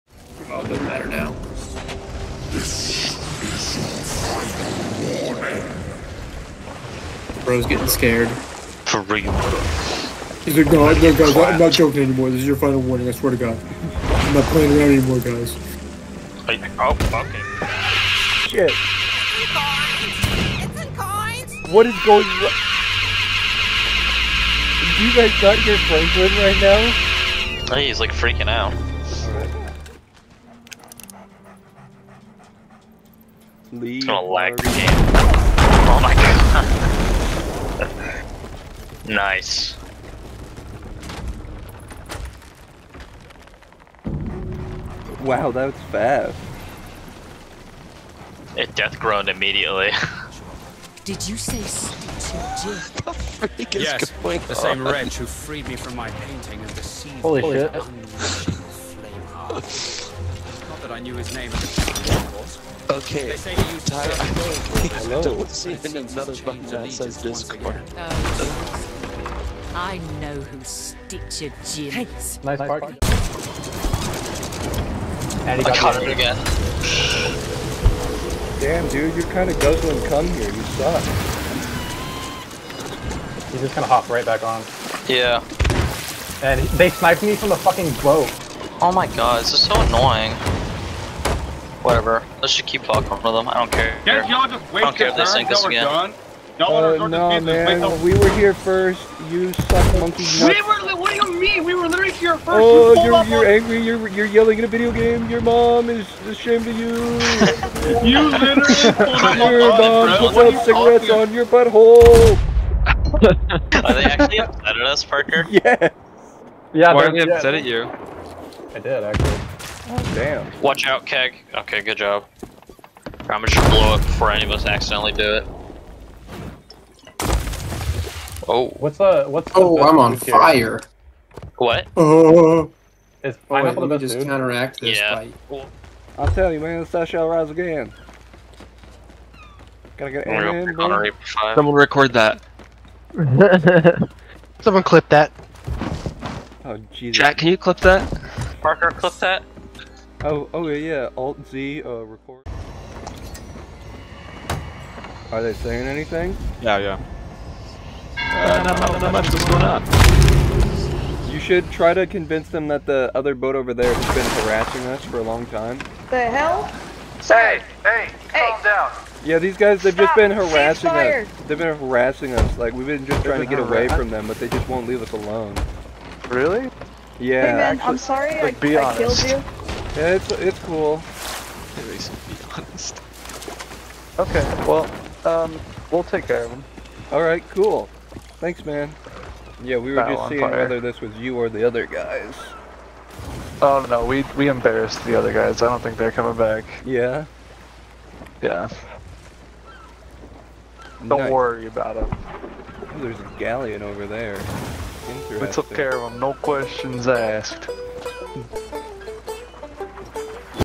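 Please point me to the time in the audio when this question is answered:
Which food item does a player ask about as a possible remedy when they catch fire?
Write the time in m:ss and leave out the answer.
2:13.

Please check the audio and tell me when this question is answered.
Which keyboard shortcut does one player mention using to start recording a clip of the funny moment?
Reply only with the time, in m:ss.
2:31.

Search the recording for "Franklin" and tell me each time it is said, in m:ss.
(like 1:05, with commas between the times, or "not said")
0:25.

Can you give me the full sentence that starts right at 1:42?
Oh, you are you're, you're angry.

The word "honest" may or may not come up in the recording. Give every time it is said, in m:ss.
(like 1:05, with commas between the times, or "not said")
3:02.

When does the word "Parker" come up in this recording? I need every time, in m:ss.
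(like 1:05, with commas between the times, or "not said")
1:55, 2:28.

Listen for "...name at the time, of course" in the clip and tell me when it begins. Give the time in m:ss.
1:01.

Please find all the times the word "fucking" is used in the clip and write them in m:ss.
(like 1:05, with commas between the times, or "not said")
0:17, 1:27, 1:32.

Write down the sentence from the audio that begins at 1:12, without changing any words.
Nice, nice And he got I caught him again.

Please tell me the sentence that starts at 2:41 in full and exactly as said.
You should try to convince them that the other boat over there has been harassing us for a long time.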